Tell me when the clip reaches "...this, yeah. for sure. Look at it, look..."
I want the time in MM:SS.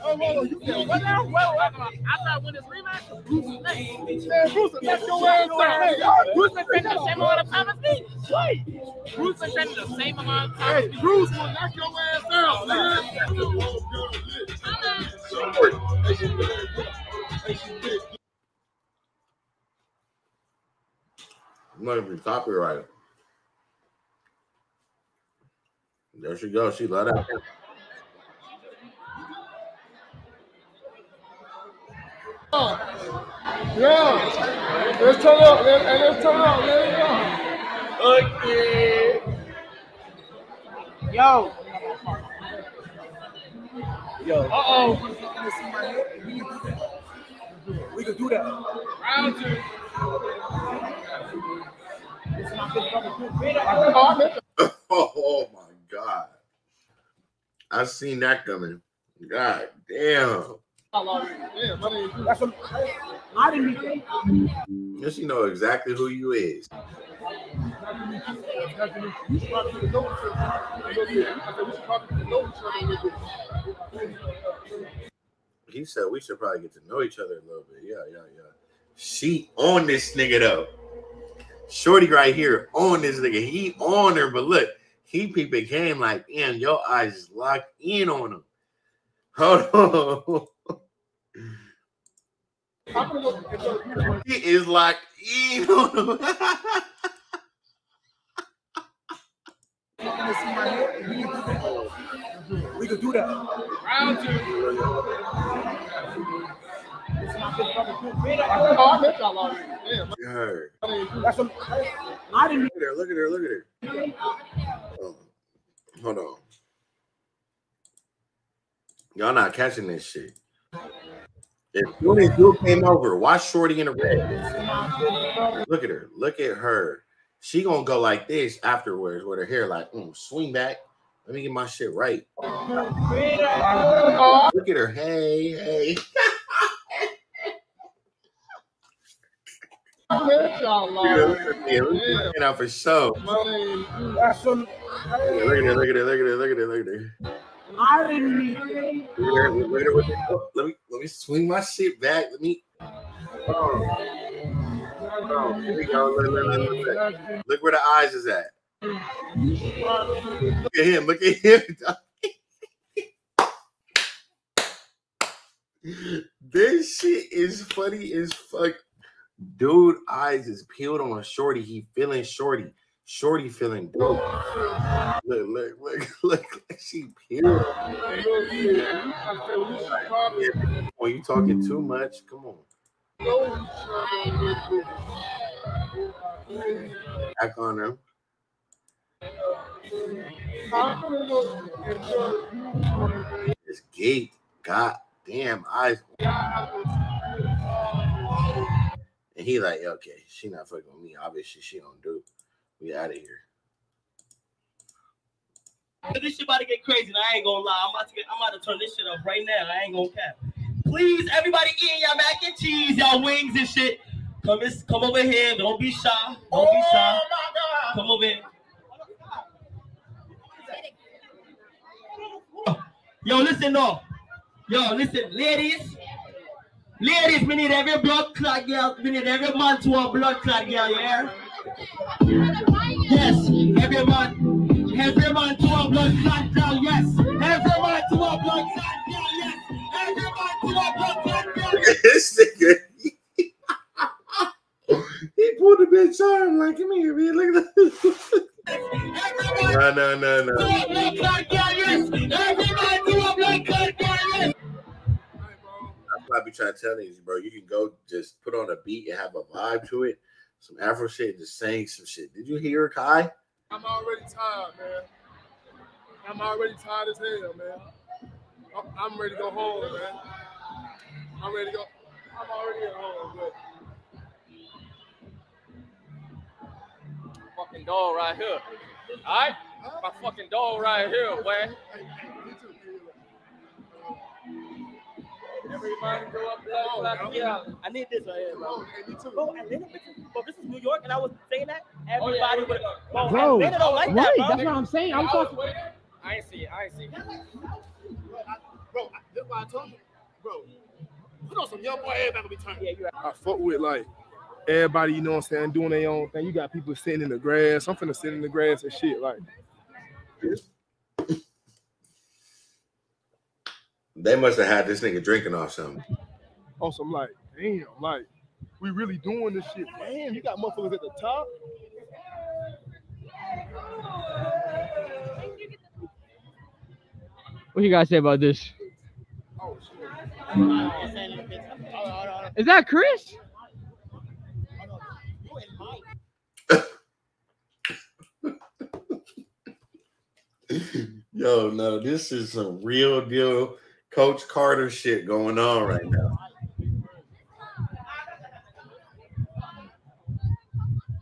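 02:20.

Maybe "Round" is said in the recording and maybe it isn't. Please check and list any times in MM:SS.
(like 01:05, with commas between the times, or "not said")
00:48, 01:43.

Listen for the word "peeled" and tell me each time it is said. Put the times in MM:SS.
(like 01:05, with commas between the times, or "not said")
02:50, 02:57.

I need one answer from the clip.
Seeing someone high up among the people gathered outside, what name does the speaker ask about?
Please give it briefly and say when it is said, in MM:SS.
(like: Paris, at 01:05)
Chris, at 05:32.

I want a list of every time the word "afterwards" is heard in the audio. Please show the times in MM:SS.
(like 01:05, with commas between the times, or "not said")
02:08.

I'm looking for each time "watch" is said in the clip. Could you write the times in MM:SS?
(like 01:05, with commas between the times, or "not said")
02:03.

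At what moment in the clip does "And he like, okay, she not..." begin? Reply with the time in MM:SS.
03:19.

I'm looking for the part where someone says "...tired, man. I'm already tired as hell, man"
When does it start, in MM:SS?
04:24.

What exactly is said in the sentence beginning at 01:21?
Shorty right here on this nigga.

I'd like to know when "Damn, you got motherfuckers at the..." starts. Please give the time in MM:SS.
05:19.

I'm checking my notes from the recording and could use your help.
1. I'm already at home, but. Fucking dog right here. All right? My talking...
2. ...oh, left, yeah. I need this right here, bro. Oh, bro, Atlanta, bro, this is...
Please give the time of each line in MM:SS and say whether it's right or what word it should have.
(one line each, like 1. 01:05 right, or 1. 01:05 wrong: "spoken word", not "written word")
1. 04:32 wrong: "fucking", not "talking"
2. 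04:46 right.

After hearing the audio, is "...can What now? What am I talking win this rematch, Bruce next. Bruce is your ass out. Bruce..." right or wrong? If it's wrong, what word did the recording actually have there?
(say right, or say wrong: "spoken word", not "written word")
right.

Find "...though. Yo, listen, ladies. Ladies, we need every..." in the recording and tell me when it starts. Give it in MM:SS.
03:43.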